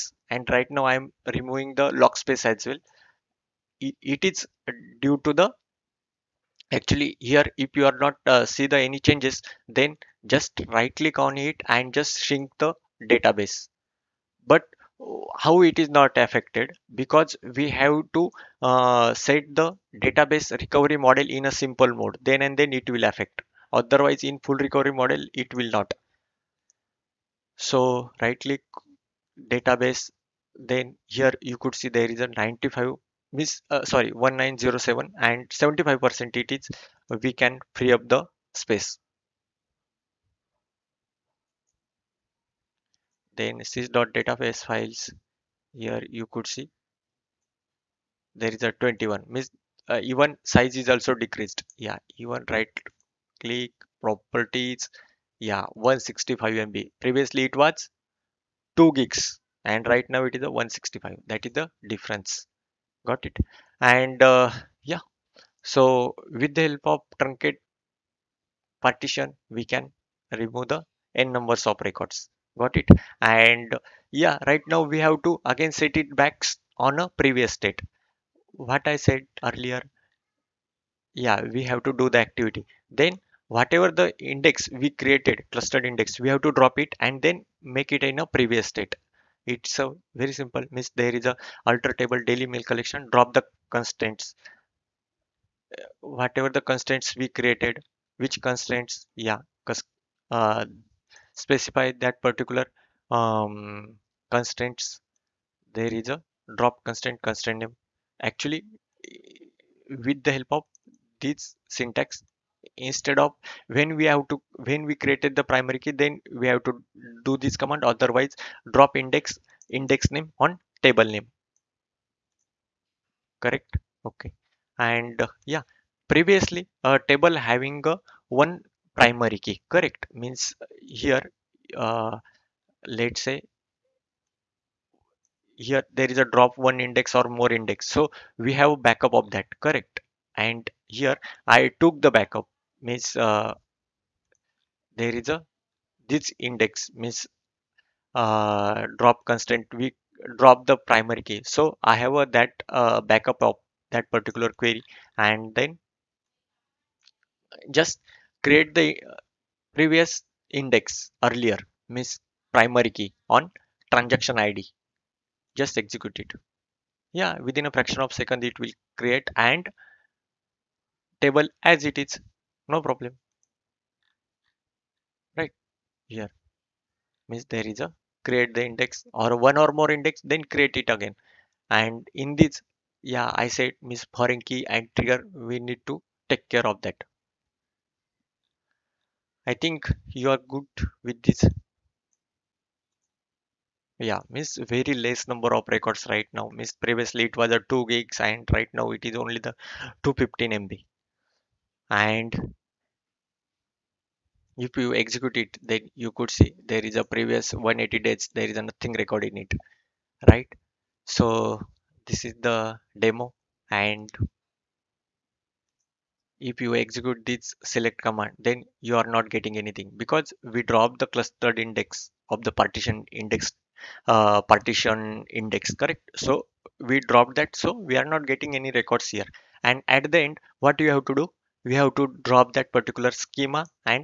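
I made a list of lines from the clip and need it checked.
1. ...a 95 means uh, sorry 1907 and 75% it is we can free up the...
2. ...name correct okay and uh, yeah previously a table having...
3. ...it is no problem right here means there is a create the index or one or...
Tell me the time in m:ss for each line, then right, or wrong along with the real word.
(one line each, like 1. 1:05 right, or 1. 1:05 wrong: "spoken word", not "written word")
1. 0:32 right
2. 2:01 right
3. 2:51 right.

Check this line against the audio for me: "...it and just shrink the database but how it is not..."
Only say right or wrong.
right.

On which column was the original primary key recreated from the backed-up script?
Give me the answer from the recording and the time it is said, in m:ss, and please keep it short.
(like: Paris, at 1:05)
Transaction ID, at 2:43.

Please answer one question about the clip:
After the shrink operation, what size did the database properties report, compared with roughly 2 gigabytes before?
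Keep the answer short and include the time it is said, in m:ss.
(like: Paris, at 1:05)
165 MB, at 0:55.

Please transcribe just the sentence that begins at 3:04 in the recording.
foreign key and trigger we need to take care of that i think you are good with this yeah Miss.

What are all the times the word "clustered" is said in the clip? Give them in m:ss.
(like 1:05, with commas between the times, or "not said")
1:25, 3:41.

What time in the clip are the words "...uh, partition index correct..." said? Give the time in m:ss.
3:44.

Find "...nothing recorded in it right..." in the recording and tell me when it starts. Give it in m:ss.
3:28.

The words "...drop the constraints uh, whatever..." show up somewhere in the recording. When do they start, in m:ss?
1:33.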